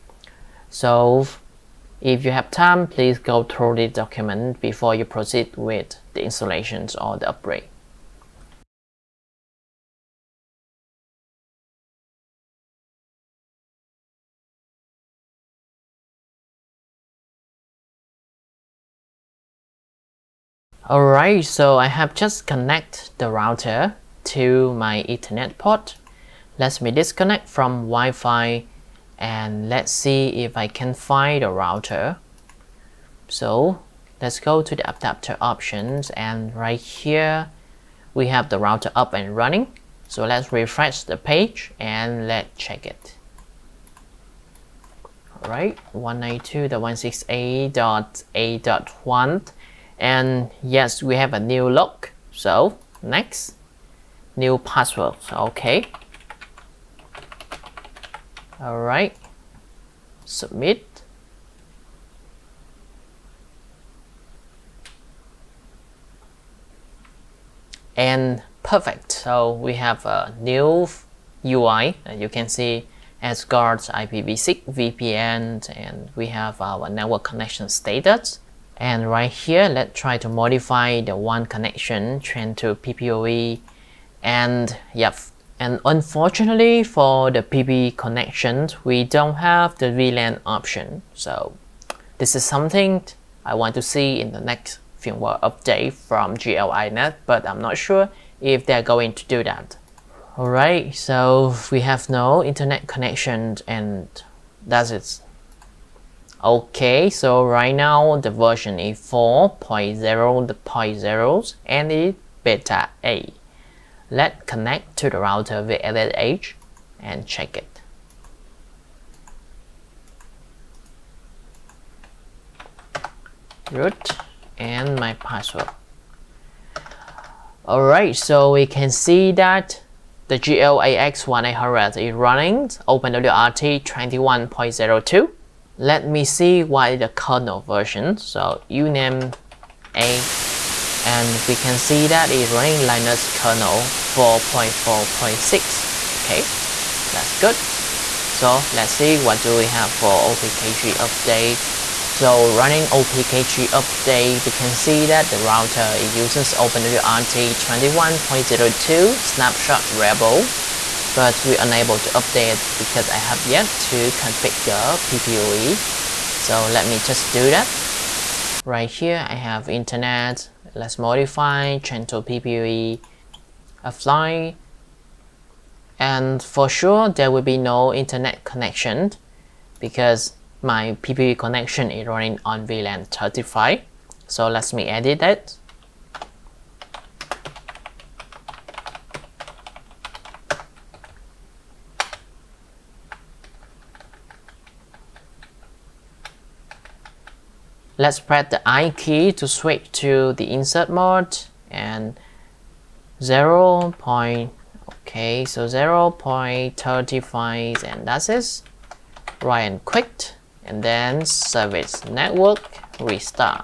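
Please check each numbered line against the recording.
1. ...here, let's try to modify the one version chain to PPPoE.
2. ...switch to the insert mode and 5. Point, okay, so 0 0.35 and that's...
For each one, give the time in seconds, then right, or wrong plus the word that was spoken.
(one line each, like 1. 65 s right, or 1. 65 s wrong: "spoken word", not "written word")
1. 79 s wrong: "connection", not "version"
2. 199 s wrong: "0", not "5".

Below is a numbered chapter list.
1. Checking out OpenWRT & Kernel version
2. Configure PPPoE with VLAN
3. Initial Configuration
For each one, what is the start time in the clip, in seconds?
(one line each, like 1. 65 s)
1. 125 s
2. 167 s
3. 46 s.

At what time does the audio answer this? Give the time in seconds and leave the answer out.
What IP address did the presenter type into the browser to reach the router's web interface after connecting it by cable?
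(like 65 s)
45 s.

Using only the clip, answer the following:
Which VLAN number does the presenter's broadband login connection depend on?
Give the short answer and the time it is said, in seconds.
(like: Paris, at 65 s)
35, at 182 s.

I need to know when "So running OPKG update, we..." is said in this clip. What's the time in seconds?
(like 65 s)
152 s.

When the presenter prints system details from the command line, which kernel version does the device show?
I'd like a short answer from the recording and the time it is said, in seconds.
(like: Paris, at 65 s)
4.4.6, at 143 s.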